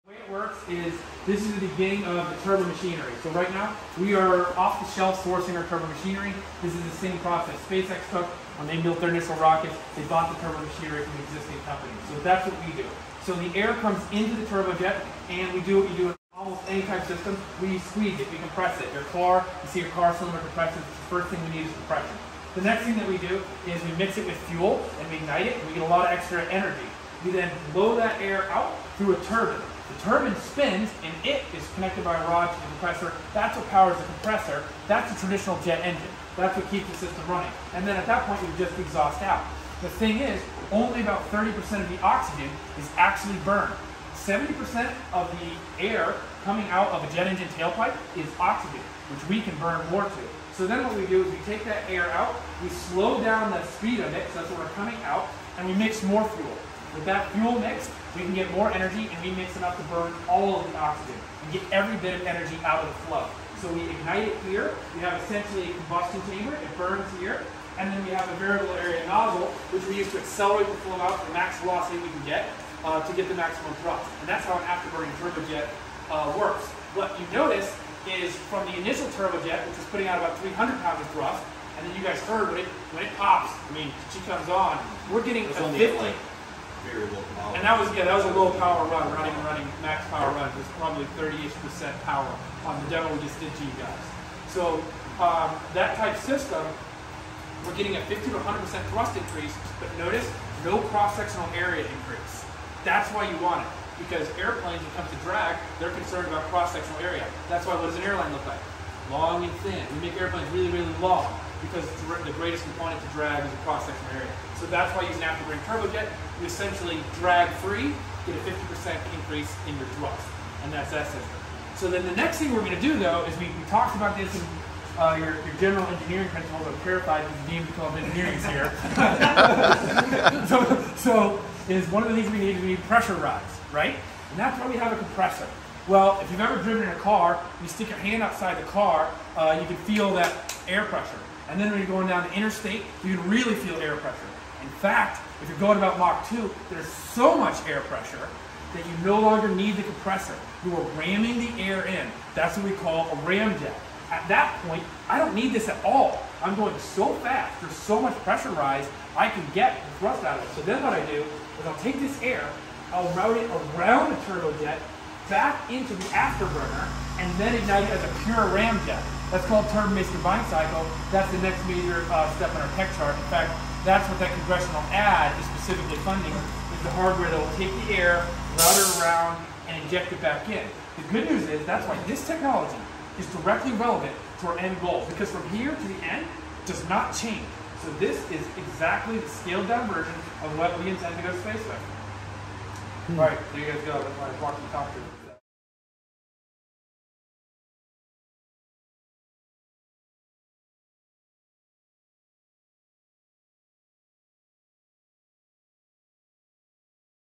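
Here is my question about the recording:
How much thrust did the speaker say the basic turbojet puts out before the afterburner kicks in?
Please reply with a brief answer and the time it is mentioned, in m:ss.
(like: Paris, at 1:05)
300 pounds, at 1:20.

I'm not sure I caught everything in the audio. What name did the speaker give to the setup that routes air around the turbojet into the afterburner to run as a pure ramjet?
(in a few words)
turbine-based combined cycle.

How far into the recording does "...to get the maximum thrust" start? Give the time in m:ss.
1:13.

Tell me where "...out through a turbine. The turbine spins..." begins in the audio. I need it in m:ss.
0:28.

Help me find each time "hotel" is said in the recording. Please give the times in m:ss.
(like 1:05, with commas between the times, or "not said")
not said.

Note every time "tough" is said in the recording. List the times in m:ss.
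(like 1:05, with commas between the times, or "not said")
not said.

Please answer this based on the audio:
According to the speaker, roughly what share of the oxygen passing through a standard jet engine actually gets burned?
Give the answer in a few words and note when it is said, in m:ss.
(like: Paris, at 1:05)
30%, at 0:40.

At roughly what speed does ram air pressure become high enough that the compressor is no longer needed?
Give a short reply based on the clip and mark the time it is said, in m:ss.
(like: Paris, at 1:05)
Mach 2, at 2:25.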